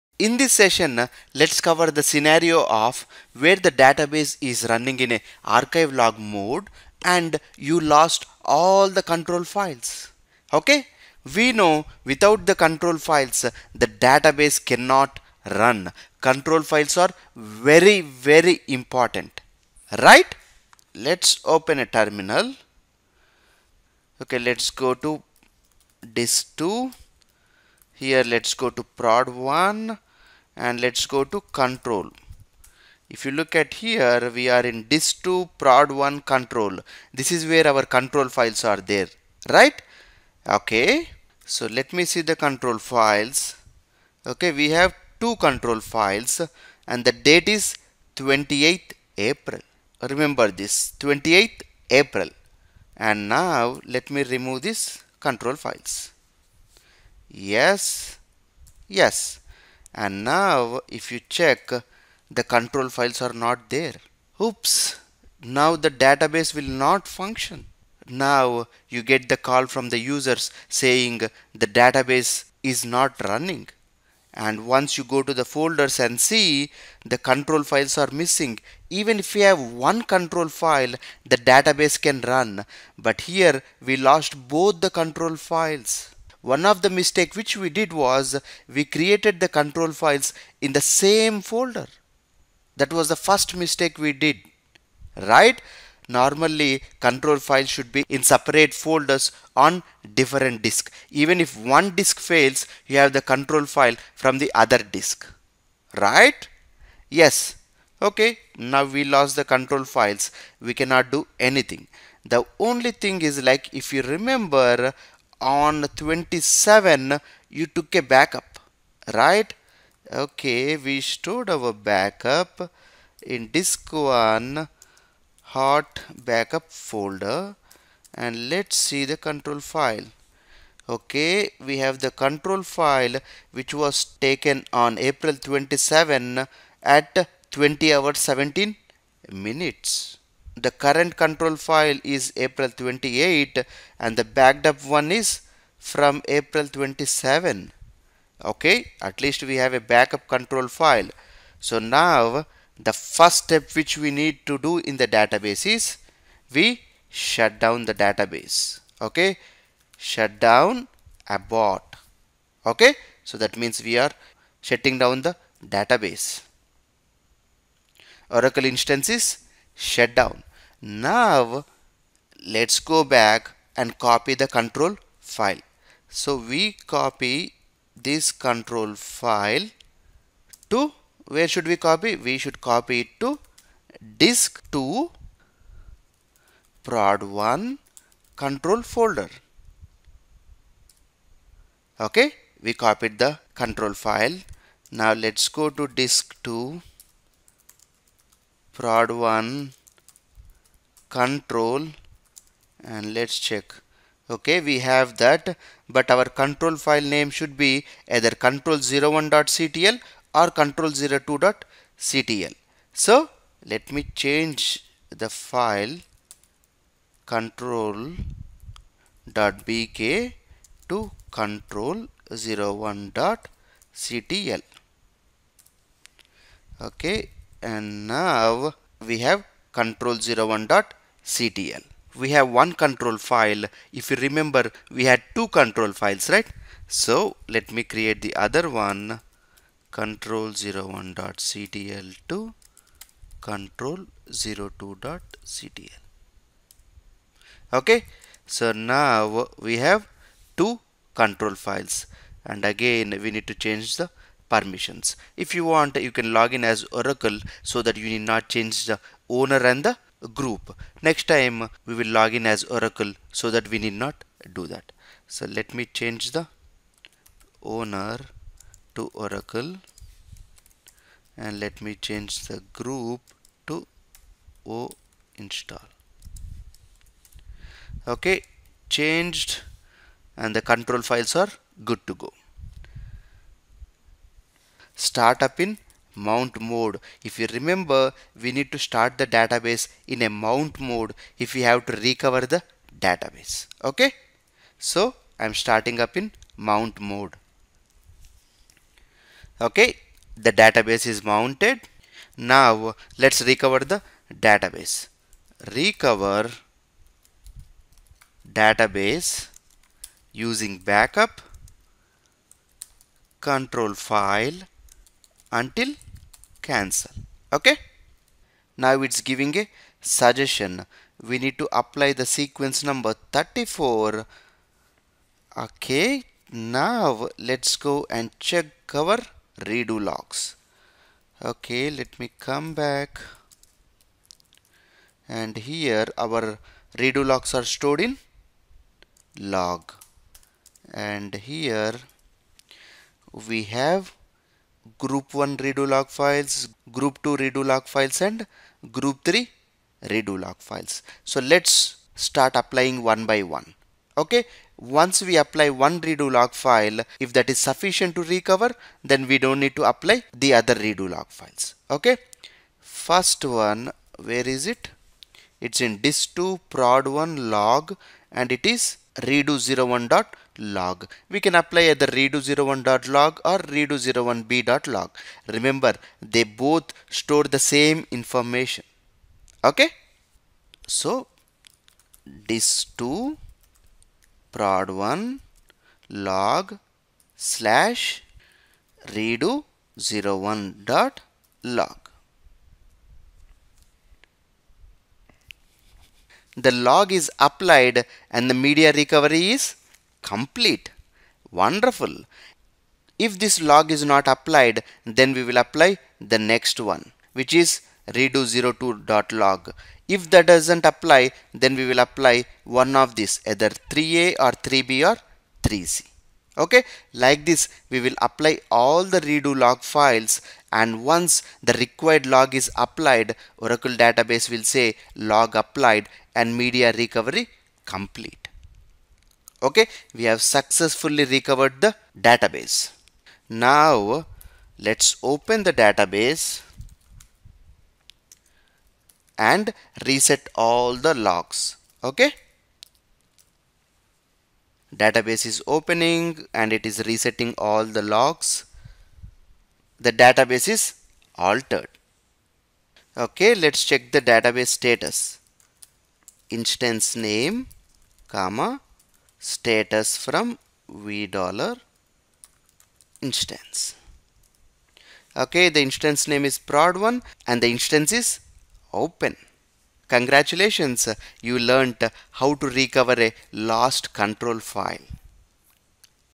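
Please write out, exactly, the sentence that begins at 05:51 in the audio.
So let's start applying one by one.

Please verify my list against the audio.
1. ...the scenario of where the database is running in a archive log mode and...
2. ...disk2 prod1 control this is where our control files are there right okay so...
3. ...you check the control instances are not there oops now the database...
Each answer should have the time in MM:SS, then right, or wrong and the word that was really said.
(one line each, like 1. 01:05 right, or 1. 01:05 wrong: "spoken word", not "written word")
1. 00:01 right
2. 00:34 right
3. 01:01 wrong: "files", not "instances".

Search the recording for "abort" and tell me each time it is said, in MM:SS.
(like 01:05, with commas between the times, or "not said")
02:41.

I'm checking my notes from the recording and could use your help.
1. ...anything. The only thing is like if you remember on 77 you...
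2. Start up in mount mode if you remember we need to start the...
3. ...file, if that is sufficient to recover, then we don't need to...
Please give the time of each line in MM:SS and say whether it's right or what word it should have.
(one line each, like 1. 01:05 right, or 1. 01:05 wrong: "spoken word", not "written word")
1. 01:51 wrong: "27", not "77"
2. 04:45 right
3. 05:56 right.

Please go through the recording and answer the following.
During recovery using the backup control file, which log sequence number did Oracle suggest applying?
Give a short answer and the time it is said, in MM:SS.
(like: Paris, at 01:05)
34, at 05:23.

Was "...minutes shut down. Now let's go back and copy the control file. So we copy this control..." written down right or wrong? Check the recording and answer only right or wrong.
wrong.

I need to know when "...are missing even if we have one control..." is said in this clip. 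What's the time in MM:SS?
01:17.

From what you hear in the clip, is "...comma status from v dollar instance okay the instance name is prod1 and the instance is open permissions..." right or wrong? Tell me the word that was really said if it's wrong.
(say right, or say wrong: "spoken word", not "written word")
wrong: "congratulations", not "permissions".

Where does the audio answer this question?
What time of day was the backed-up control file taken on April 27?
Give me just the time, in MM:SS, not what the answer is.
02:17.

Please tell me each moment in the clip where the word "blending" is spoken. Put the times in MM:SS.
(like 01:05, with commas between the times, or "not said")
not said.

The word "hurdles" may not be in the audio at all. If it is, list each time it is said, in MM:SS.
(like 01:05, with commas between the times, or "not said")
not said.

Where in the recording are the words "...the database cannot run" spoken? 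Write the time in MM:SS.
00:13.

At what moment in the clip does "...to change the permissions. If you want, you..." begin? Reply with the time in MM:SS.
04:13.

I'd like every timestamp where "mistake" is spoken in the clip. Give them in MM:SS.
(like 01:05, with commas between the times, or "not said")
01:26, 01:33.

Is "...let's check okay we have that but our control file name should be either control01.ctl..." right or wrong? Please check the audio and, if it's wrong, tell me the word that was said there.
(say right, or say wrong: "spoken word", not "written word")
right.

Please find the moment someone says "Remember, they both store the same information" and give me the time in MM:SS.
06:15.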